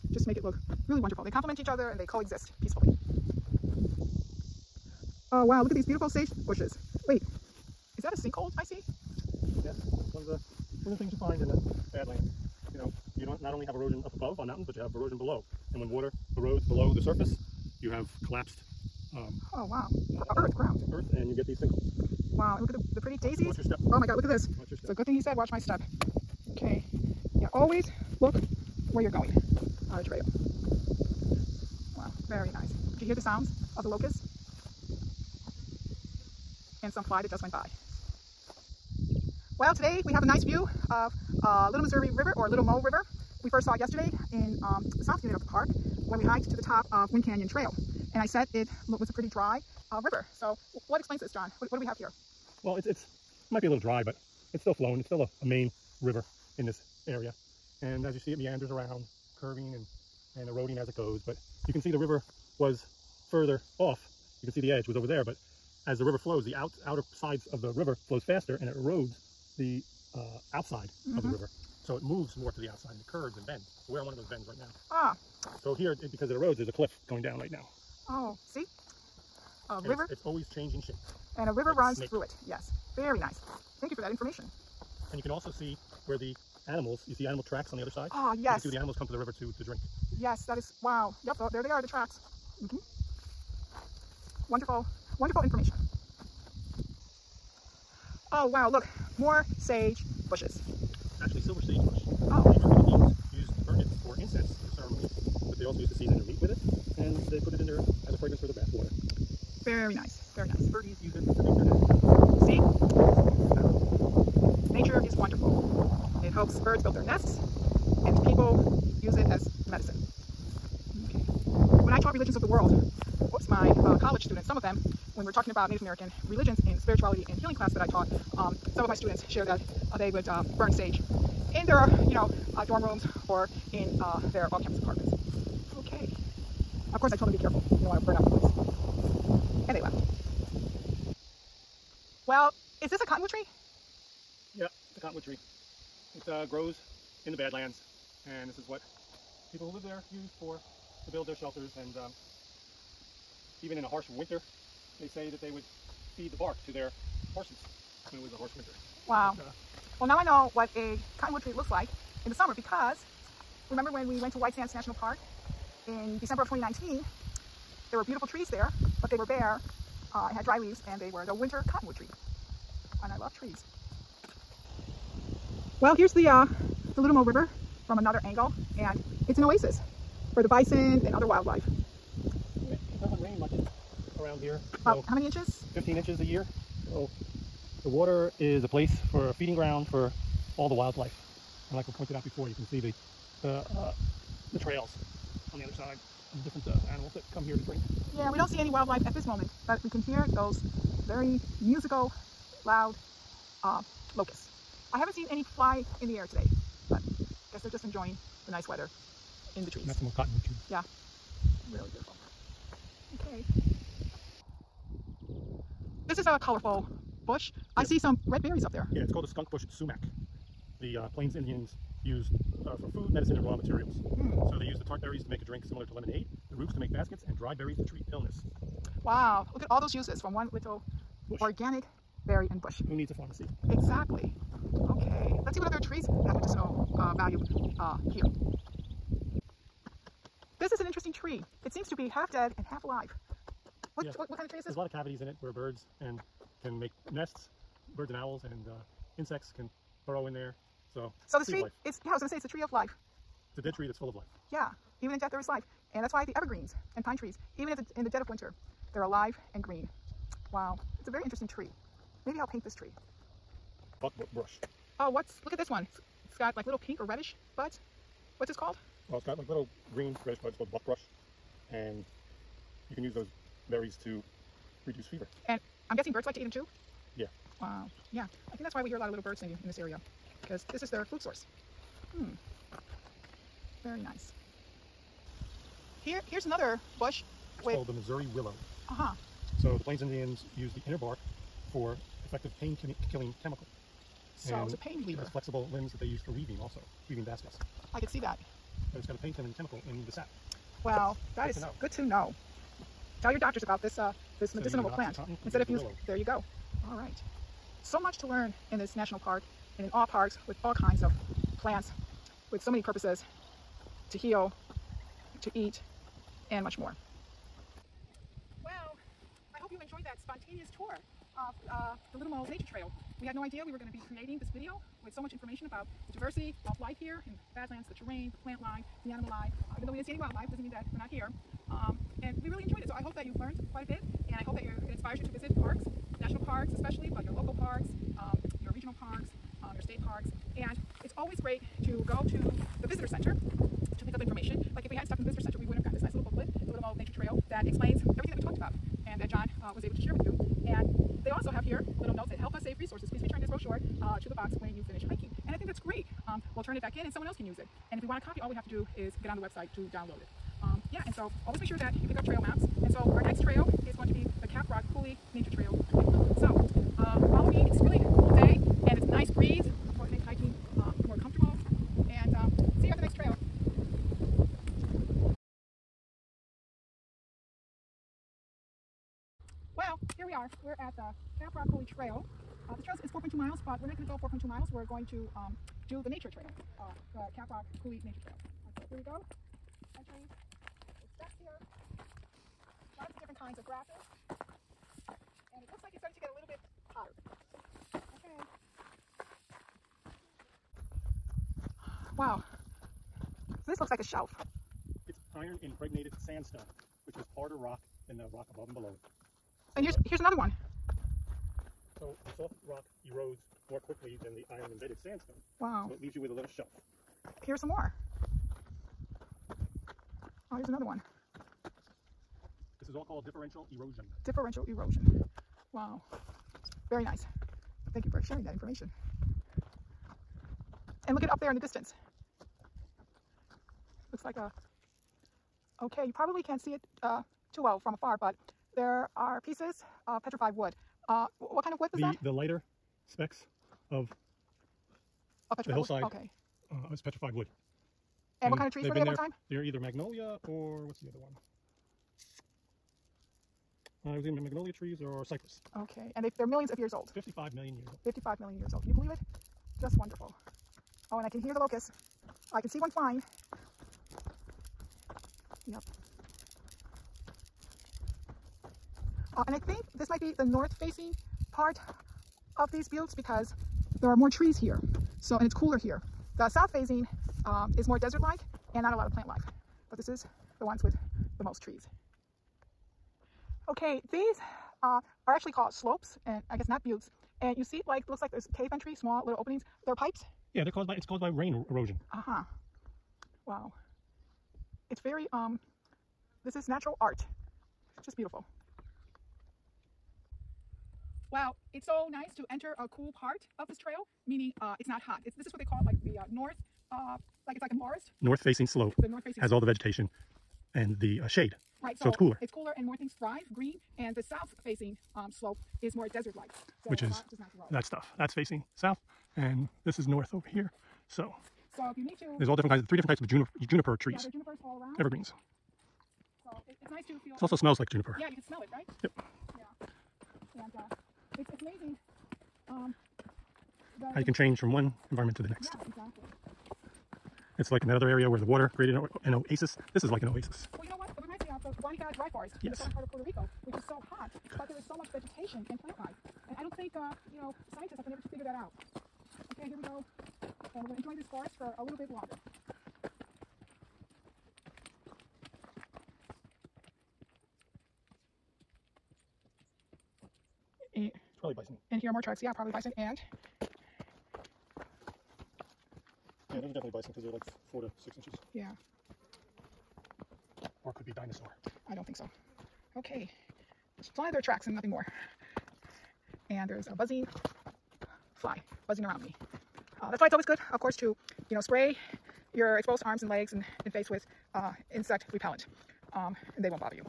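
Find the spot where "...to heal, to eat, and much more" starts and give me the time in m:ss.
5:14.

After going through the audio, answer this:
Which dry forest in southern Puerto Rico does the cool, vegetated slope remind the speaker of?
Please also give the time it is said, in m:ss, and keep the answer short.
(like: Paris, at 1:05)
Guanica dry forest, at 9:01.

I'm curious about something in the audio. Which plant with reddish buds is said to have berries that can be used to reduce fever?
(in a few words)
buckbrush.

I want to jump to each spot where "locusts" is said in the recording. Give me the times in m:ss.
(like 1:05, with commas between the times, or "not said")
0:33, 3:24, 7:41.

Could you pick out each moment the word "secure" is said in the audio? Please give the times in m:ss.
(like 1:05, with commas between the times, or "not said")
not said.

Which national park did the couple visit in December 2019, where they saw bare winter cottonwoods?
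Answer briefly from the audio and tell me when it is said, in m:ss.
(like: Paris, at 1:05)
White Sands National Park, at 2:44.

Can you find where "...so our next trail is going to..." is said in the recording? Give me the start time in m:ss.
6:02.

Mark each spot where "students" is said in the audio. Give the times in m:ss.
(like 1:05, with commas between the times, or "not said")
2:04, 2:08.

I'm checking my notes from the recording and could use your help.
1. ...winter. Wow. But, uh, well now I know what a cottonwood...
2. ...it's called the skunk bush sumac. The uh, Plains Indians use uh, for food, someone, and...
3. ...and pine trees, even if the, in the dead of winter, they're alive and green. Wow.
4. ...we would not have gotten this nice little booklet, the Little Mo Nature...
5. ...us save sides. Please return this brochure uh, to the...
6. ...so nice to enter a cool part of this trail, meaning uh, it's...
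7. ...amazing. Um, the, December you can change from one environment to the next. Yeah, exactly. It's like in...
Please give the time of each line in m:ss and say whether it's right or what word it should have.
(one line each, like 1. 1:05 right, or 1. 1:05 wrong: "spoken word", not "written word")
1. 2:38 right
2. 3:39 wrong: "medicine", not "someone"
3. 4:16 right
4. 5:45 right
5. 5:52 wrong: "resources", not "sides"
6. 8:21 right
7. 8:51 wrong: "How", not "December".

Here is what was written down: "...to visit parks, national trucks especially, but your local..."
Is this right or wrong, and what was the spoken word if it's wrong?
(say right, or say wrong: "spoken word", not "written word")
wrong: "parks", not "trucks".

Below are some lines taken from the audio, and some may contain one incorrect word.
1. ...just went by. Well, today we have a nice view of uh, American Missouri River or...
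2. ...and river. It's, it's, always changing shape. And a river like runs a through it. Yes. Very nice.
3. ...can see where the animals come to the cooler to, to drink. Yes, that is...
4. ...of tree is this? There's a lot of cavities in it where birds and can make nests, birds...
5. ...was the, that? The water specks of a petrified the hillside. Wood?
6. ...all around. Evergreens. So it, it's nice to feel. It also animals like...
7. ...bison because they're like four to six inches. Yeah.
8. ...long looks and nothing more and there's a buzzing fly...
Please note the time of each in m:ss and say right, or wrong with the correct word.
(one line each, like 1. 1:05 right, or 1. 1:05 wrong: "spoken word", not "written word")
1. 0:37 wrong: "Little", not "American"
2. 1:19 right
3. 1:28 wrong: "river", not "cooler"
4. 4:04 right
5. 7:21 wrong: "lighter", not "water"
6. 8:44 wrong: "smells", not "animals"
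7. 9:26 right
8. 9:34 wrong: "tracks", not "looks".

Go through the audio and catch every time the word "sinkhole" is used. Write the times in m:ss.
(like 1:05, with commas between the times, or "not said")
0:08, 0:21.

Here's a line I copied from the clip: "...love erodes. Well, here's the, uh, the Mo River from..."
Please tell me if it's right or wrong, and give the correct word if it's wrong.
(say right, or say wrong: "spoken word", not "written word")
wrong: "trees", not "erodes".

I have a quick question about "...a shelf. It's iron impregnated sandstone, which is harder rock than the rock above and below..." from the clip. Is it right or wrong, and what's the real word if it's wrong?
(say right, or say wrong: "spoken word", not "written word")
right.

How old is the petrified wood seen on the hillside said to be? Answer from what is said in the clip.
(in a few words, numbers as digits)
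55 million years.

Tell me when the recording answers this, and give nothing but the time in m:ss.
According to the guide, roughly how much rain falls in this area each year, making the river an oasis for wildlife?
3:05.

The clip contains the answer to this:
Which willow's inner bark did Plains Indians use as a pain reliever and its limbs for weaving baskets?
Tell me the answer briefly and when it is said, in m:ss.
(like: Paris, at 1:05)
Missouri willow, at 4:47.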